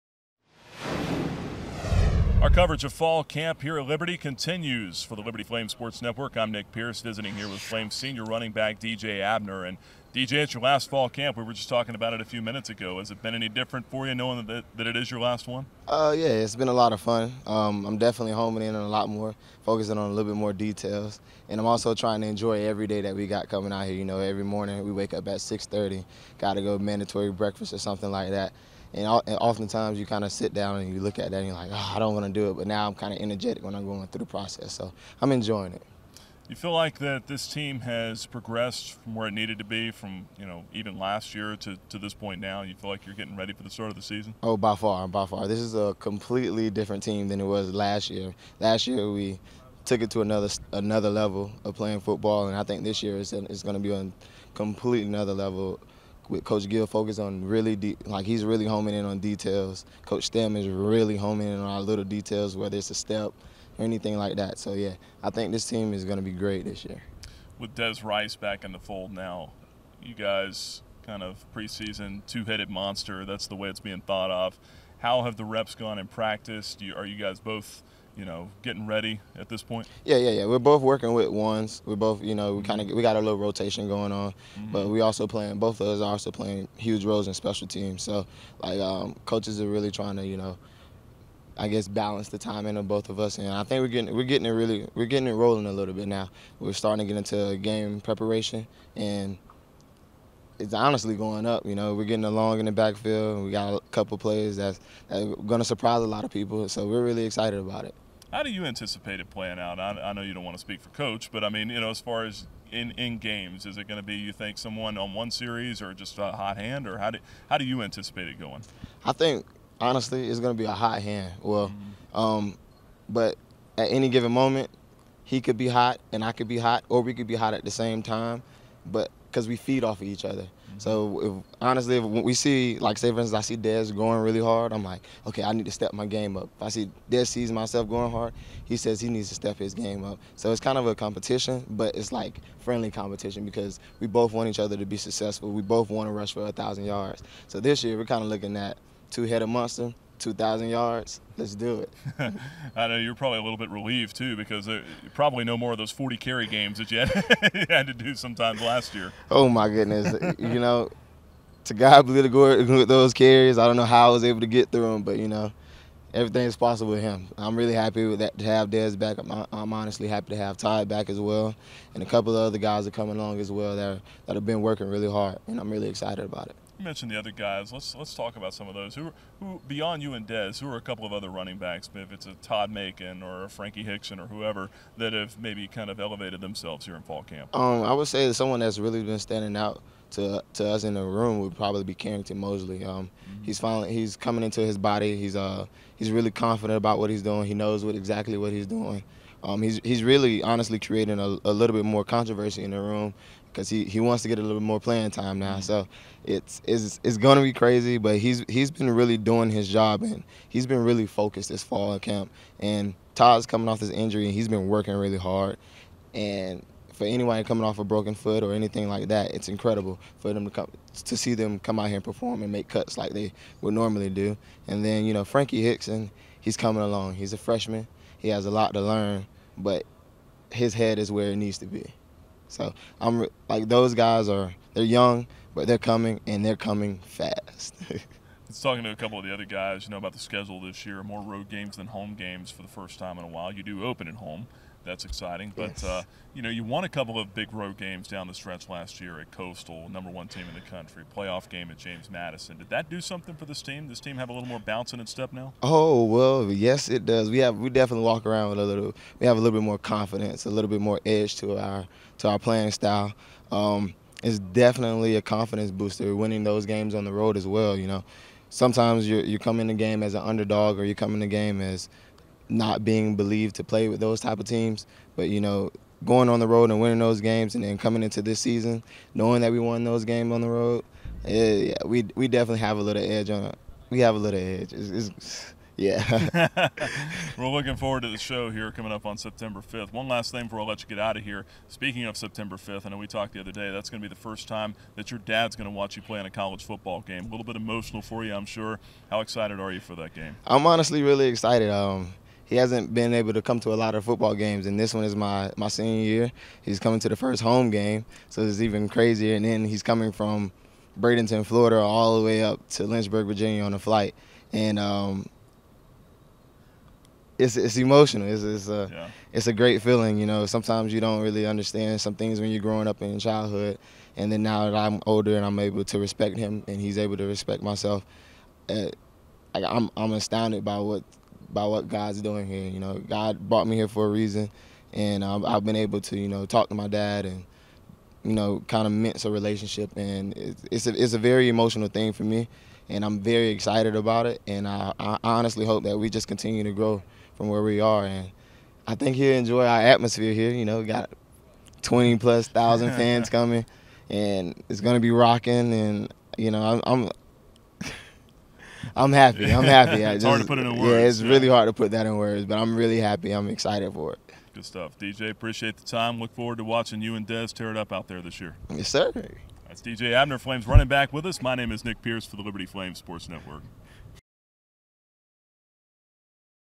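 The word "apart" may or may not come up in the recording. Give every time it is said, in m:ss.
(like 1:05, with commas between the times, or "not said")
not said.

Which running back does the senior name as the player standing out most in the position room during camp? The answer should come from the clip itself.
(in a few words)
Carrington Mosley.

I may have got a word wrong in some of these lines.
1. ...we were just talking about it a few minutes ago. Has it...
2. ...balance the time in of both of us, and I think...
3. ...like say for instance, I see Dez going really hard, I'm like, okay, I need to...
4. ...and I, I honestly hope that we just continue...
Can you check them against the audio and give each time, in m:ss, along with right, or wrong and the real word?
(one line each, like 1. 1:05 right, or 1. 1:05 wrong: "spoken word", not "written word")
1. 0:11 right
2. 1:31 right
3. 2:12 right
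4. 5:44 right.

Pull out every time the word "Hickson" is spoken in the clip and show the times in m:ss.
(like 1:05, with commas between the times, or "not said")
3:03, 3:45.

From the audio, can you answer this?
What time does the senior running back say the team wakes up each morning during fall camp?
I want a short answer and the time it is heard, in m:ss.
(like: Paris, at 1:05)
6:30, at 0:25.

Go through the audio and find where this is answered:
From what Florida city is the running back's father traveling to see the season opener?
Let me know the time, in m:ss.
5:10.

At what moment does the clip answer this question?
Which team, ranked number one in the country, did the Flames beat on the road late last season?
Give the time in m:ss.
4:09.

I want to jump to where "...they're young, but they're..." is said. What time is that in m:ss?
3:54.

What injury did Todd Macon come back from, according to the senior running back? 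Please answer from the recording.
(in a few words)
Broken foot.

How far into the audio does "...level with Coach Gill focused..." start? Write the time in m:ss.
0:55.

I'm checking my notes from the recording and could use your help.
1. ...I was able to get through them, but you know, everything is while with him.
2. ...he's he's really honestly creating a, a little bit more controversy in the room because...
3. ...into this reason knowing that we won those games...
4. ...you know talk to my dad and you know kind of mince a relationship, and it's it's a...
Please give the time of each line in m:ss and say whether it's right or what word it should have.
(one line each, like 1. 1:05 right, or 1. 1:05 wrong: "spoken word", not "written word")
1. 2:44 wrong: "possible", not "while"
2. 3:19 right
3. 4:38 wrong: "season", not "reason"
4. 5:36 right.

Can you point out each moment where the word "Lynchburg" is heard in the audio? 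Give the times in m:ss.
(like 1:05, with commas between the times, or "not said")
5:12.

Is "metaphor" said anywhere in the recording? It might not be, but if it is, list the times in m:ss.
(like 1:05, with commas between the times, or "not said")
not said.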